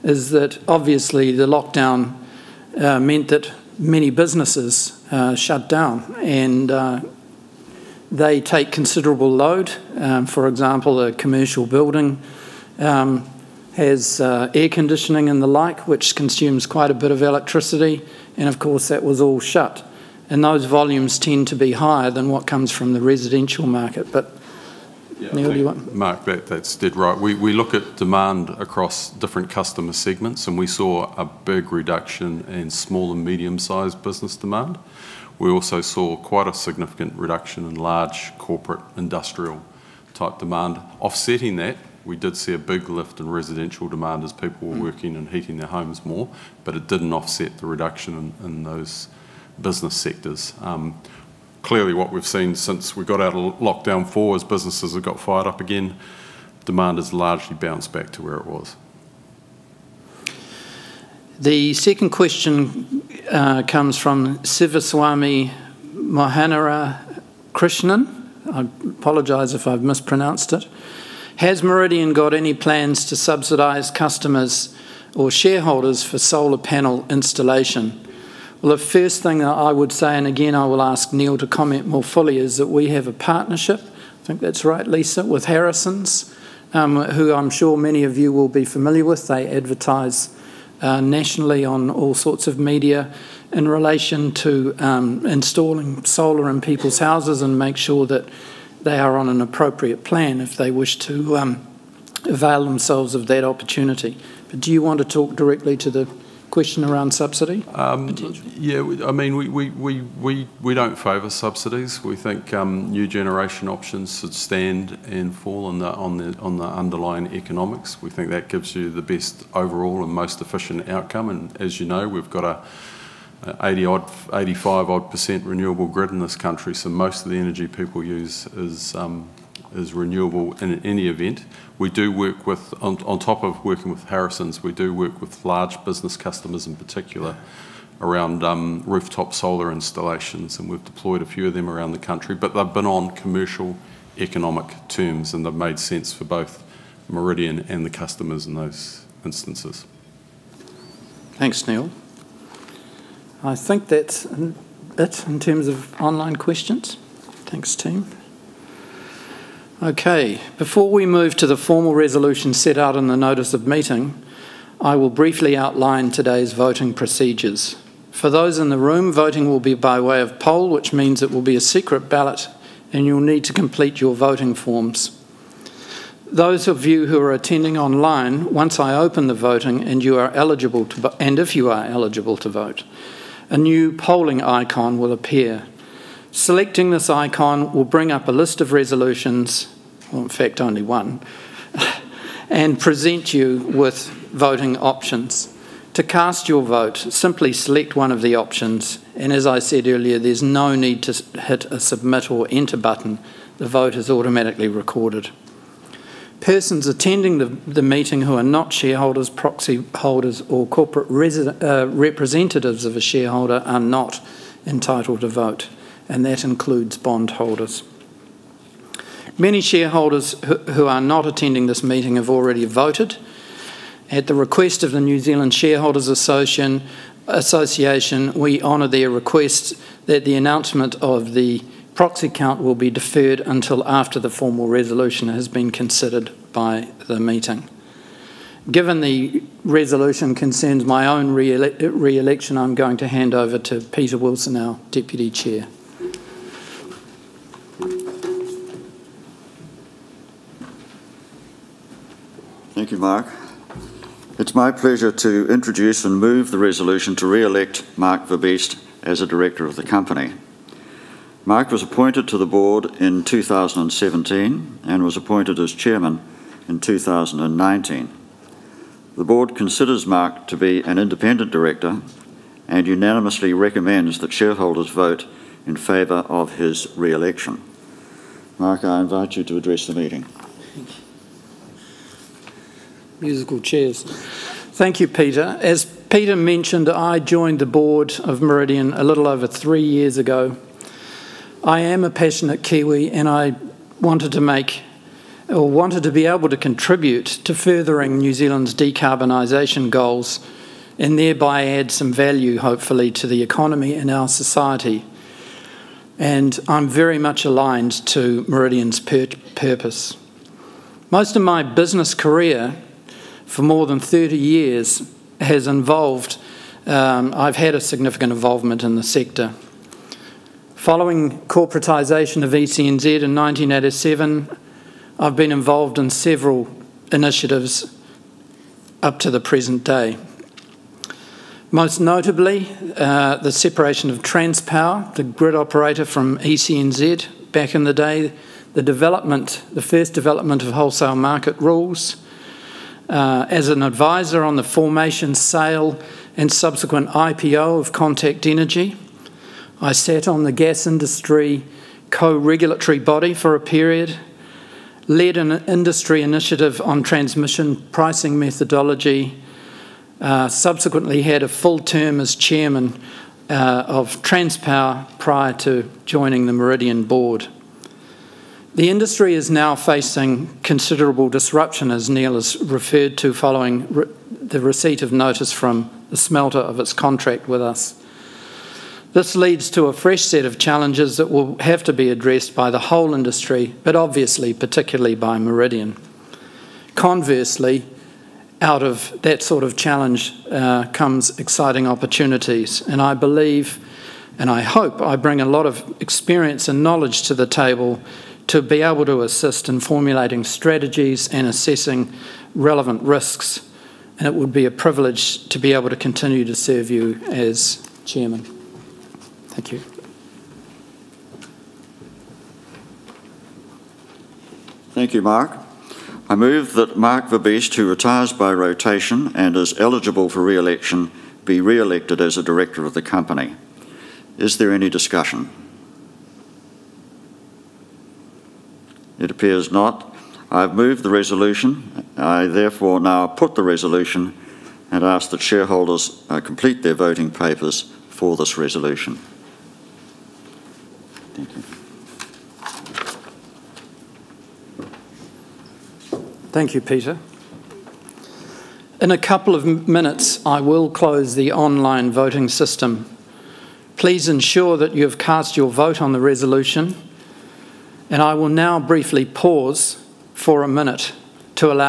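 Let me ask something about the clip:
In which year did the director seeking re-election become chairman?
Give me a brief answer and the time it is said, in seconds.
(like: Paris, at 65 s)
2019, at 266 s.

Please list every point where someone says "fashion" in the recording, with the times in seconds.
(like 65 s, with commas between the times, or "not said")
not said.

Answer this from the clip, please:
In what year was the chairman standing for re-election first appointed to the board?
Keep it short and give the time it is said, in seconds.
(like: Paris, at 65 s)
2017, at 263 s.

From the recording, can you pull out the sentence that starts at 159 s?
Okay, before we move to the formal resolution set out in the notice of meeting, I will briefly outline today's voting procedures.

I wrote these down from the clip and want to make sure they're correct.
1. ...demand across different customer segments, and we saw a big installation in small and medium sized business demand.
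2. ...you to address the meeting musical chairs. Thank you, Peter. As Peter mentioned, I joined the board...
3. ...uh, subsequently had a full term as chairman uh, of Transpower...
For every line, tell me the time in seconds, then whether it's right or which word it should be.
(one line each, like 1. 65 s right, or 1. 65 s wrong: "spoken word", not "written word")
1. 27 s wrong: "reduction", not "installation"
2. 279 s right
3. 360 s right.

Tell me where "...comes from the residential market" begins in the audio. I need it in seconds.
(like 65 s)
22 s.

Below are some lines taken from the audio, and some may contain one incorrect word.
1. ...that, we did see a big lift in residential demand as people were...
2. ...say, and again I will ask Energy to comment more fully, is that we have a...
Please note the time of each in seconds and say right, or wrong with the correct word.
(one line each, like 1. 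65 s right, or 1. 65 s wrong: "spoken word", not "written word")
1. 41 s right
2. 79 s wrong: "Neal", not "Energy".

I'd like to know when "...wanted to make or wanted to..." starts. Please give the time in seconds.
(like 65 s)
294 s.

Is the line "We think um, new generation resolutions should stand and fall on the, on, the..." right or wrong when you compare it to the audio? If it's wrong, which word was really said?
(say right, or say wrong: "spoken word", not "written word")
wrong: "options", not "resolutions".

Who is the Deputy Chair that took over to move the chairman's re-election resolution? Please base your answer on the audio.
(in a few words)
Peter Wilson.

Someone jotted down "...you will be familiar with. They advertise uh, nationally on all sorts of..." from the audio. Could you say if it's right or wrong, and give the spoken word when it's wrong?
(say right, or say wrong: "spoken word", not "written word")
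right.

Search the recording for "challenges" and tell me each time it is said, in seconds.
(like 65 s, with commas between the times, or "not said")
380 s, 389 s.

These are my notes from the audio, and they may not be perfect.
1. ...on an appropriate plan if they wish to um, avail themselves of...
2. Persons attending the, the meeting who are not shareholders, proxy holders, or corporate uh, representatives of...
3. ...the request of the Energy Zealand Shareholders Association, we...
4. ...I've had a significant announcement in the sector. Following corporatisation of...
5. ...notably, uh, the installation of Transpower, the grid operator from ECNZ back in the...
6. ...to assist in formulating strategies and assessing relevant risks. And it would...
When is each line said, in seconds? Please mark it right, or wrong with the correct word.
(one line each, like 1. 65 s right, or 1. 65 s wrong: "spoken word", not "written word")
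1. 99 s right
2. 206 s right
3. 224 s wrong: "New", not "Energy"
4. 317 s wrong: "involvement", not "announcement"
5. 331 s wrong: "separation", not "installation"
6. 399 s right.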